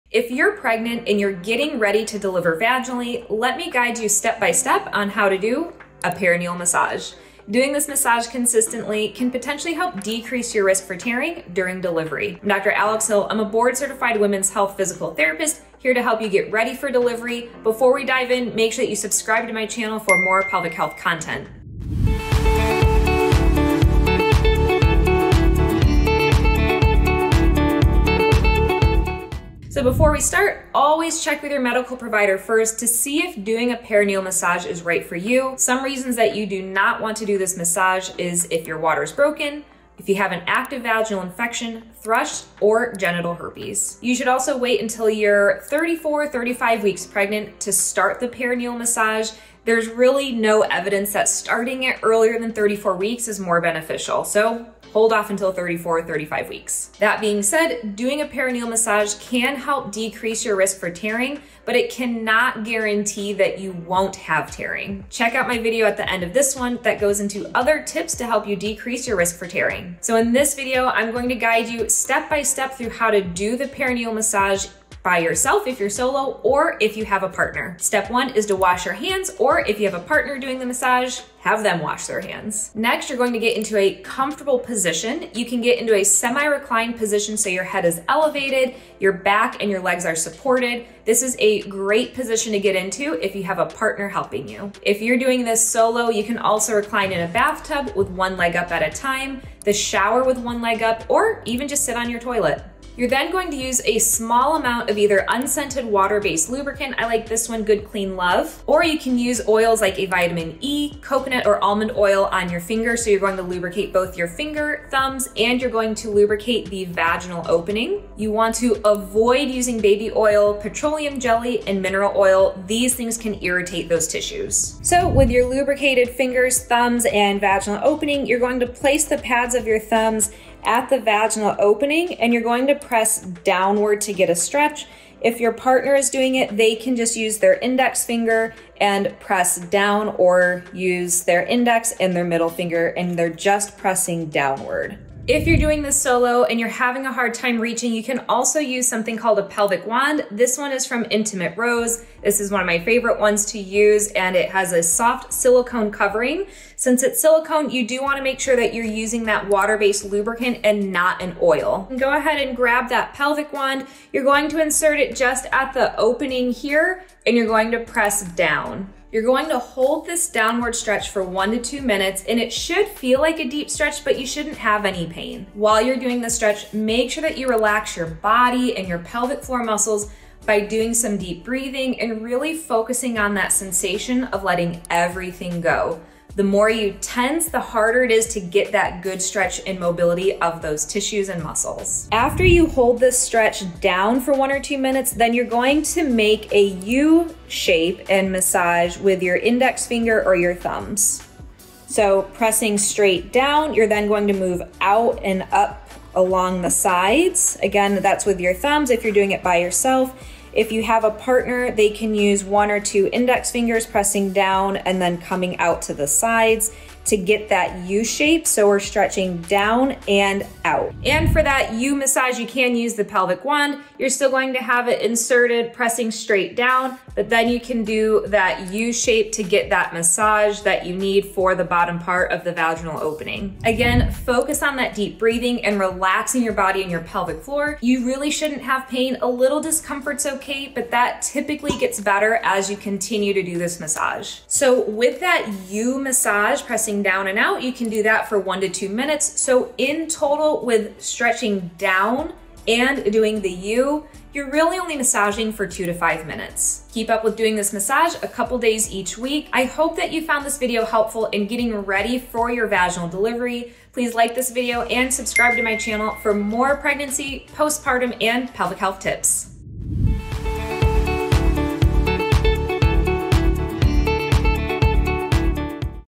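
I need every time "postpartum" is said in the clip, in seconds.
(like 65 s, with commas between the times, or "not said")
267 s.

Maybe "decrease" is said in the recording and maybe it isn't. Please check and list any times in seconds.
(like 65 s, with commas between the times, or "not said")
10 s, 59 s, 68 s.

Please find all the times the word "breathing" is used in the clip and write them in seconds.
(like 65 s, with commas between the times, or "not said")
181 s, 235 s.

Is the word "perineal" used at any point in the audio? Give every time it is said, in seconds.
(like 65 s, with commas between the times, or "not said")
6 s, 33 s, 48 s, 58 s, 73 s.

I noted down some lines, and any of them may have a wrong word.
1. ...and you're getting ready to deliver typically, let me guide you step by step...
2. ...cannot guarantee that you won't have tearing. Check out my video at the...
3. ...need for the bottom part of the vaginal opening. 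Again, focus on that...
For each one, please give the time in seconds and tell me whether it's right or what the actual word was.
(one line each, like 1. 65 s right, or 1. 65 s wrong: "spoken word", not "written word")
1. 1 s wrong: "vaginally", not "typically"
2. 61 s right
3. 230 s right.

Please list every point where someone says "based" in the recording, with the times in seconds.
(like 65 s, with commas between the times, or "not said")
105 s, 159 s.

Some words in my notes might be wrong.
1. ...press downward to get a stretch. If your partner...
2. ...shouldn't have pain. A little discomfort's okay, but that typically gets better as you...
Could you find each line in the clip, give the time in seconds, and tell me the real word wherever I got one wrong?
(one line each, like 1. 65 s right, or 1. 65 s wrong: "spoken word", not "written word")
1. 132 s right
2. 238 s right.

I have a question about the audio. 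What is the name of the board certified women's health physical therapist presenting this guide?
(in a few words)
Alex Hill.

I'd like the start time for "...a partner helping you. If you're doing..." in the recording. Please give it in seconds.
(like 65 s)
93 s.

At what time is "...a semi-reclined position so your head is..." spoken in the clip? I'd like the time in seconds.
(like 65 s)
85 s.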